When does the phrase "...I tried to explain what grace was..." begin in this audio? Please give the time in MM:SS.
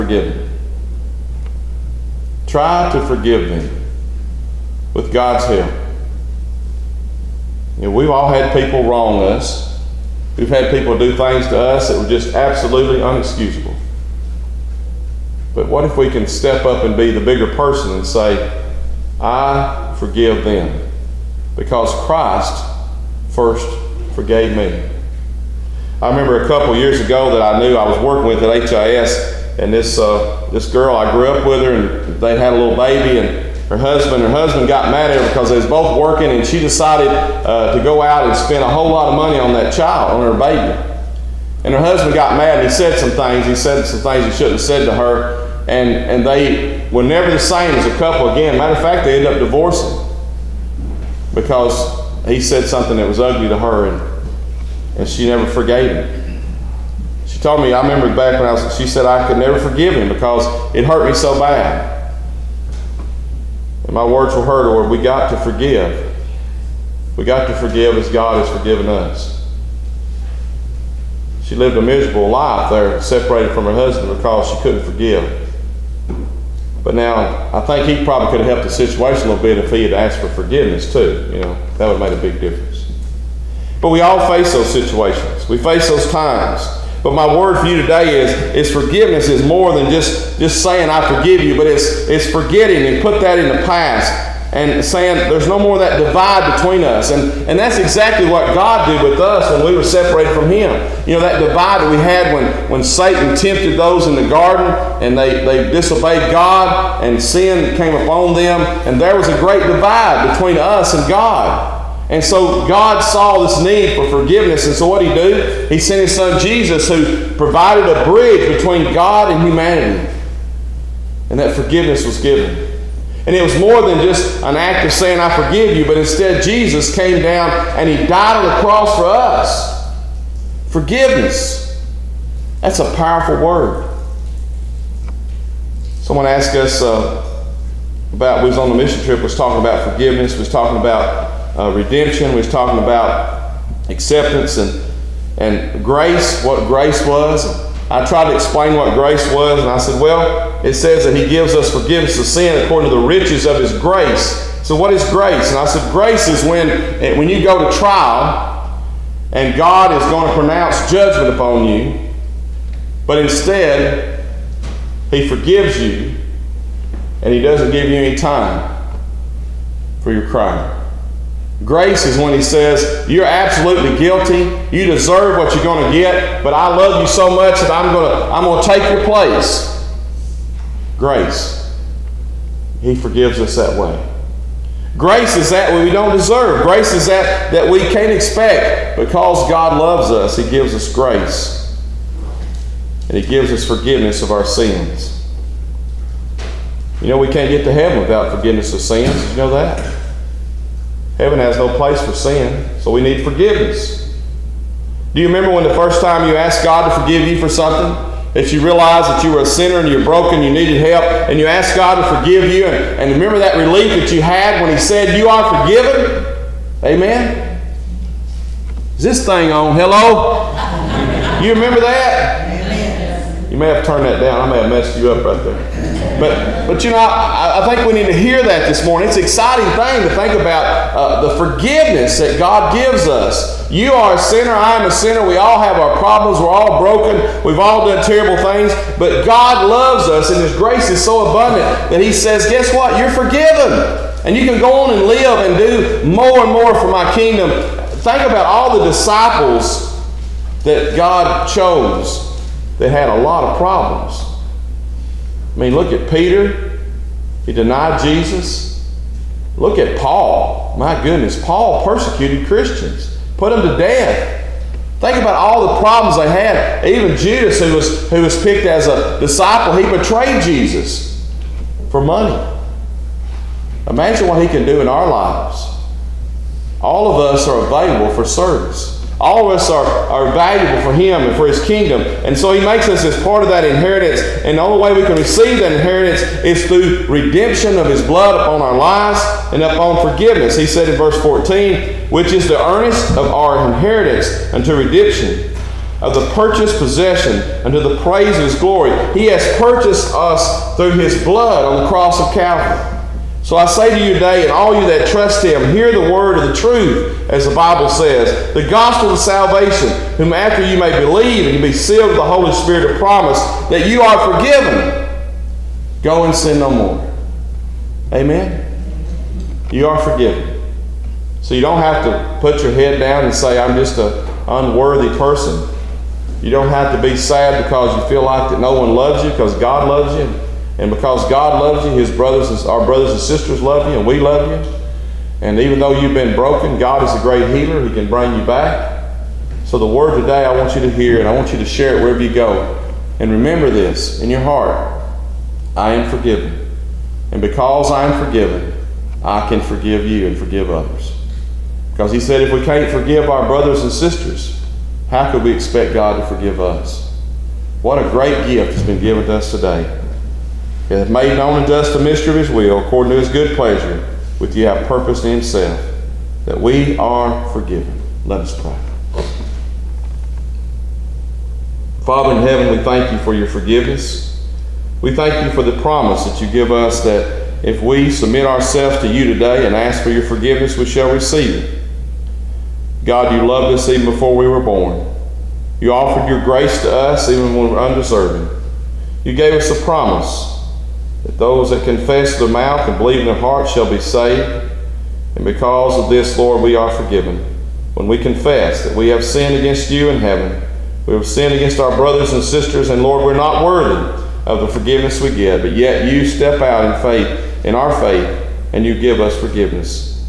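02:27.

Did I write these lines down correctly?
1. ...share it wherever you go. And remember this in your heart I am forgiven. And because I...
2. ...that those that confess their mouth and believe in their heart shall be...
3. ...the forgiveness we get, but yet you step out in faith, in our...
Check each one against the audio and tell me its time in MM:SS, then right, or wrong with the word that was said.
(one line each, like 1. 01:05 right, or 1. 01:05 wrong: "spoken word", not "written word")
1. 05:41 right
2. 06:31 right
3. 06:44 right.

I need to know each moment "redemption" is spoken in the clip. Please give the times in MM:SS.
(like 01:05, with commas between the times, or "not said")
02:21, 04:47, 04:54.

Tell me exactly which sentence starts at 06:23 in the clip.
God, you loved us even before we were born.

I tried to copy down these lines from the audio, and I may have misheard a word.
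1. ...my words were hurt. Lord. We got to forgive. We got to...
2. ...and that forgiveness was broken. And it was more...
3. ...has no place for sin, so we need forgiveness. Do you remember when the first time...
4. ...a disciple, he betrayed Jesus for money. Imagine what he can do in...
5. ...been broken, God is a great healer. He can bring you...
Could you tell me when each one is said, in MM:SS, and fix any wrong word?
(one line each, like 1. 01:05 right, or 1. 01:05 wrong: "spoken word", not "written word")
1. 01:03 right
2. 02:01 wrong: "given", not "broken"
3. 03:21 right
4. 04:28 right
5. 05:36 right.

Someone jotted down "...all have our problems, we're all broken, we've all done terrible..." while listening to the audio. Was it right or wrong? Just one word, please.
right.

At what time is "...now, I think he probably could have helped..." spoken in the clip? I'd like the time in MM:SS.
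01:16.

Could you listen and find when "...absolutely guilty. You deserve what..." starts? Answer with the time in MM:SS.
02:53.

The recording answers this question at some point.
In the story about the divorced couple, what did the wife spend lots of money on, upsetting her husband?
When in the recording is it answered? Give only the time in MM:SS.
00:40.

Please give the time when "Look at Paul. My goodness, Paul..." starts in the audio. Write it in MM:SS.
04:19.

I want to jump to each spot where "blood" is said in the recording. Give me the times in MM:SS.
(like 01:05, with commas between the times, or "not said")
04:48, 05:01.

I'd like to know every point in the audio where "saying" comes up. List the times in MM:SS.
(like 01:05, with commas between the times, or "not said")
01:30, 01:34, 02:04.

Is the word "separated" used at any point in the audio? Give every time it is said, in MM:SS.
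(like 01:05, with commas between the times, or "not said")
01:13, 01:39.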